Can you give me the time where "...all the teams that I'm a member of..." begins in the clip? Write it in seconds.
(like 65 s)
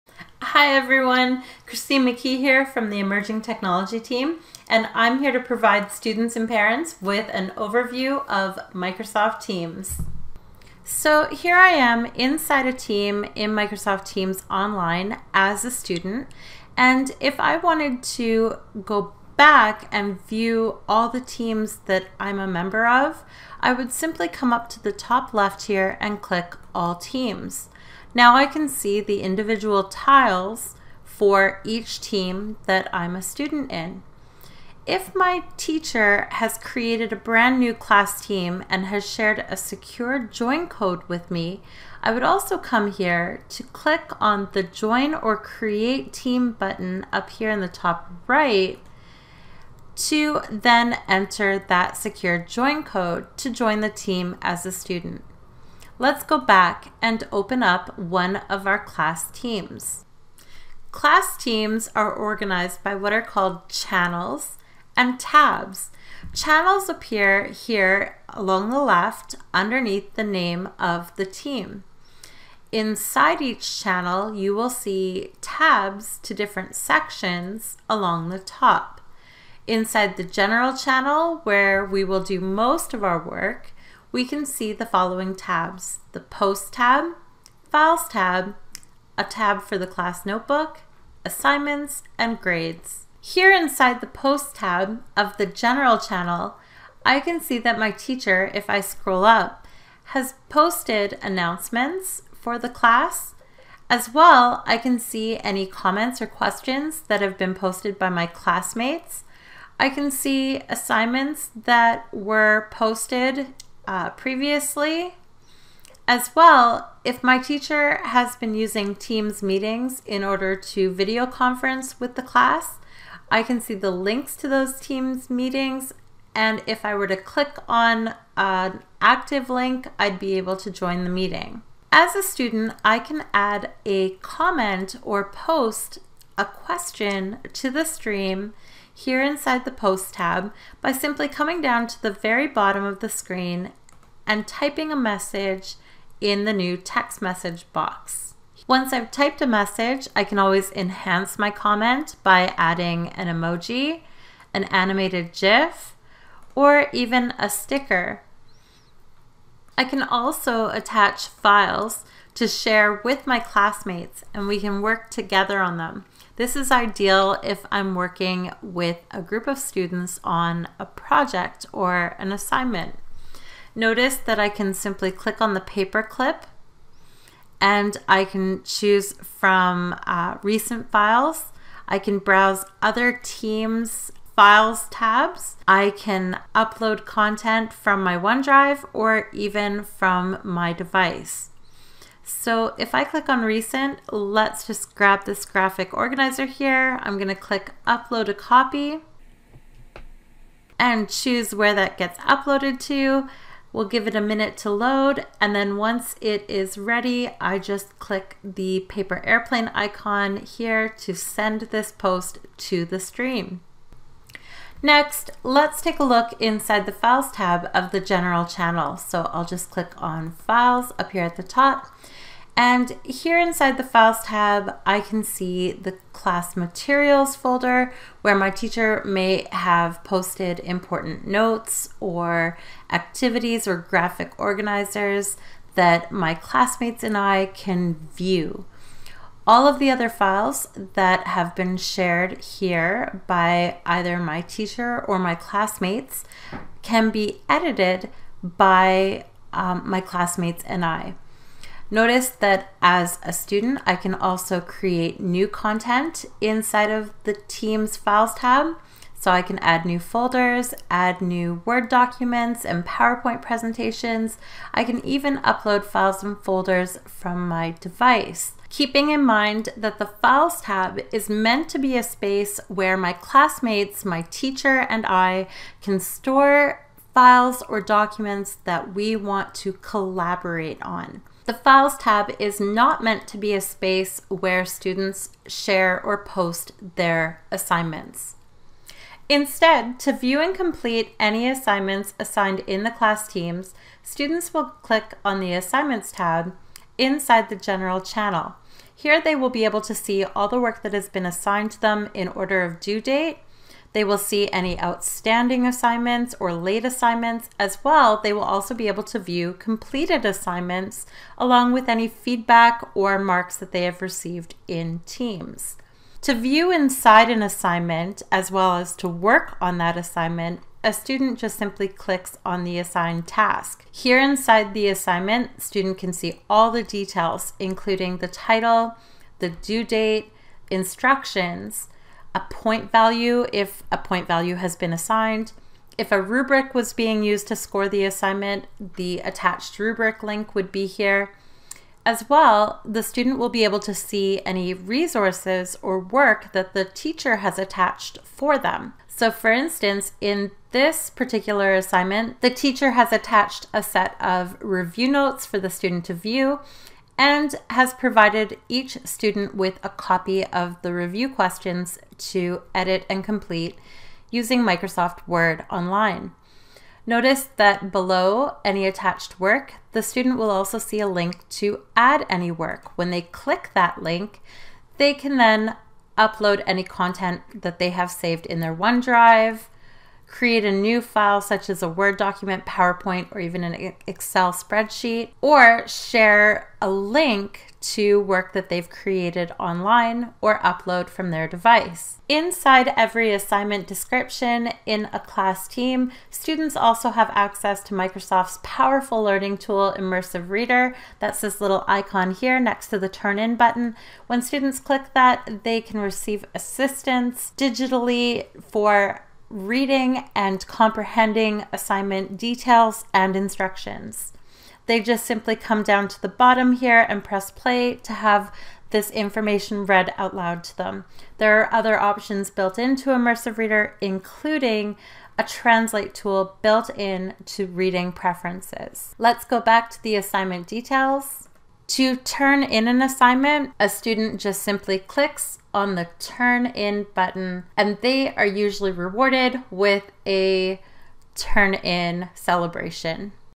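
20 s.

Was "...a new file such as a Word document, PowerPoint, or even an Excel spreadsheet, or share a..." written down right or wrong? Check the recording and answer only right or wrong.
right.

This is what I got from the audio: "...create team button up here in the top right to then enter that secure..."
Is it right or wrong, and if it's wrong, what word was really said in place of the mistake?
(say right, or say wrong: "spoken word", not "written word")
right.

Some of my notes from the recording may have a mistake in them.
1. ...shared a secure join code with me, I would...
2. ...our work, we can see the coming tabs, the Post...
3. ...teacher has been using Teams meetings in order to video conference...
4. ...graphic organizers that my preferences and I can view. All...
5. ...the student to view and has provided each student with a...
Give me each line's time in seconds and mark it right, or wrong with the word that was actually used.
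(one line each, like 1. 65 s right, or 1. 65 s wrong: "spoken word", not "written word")
1. 39 s right
2. 83 s wrong: "following", not "coming"
3. 117 s right
4. 233 s wrong: "classmates", not "preferences"
5. 355 s right.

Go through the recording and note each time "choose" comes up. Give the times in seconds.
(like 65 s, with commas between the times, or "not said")
178 s, 201 s.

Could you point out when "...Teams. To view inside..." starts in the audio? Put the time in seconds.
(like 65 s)
315 s.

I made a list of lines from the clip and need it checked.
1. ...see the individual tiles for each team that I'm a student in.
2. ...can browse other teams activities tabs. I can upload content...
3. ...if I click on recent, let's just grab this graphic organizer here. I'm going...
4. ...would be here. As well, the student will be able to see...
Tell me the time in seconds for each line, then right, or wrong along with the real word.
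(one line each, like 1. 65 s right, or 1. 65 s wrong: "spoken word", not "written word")
1. 28 s right
2. 181 s wrong: "files", not "activities"
3. 192 s right
4. 340 s right.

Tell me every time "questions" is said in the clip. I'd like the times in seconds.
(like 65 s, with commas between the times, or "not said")
106 s, 136 s, 361 s.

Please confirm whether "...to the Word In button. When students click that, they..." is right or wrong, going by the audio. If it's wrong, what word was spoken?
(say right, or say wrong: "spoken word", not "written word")
wrong: "Turn", not "Word".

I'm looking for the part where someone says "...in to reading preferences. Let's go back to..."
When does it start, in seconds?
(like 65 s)
426 s.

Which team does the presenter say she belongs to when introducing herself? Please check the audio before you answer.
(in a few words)
Emerging Technology.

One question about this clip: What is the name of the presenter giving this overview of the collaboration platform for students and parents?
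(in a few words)
Christine McKee.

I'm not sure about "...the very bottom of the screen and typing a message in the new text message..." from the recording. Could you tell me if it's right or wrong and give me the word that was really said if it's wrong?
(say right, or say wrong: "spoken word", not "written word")
right.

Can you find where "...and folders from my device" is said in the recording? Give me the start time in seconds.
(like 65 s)
266 s.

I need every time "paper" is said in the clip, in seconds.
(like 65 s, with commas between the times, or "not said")
175 s, 208 s.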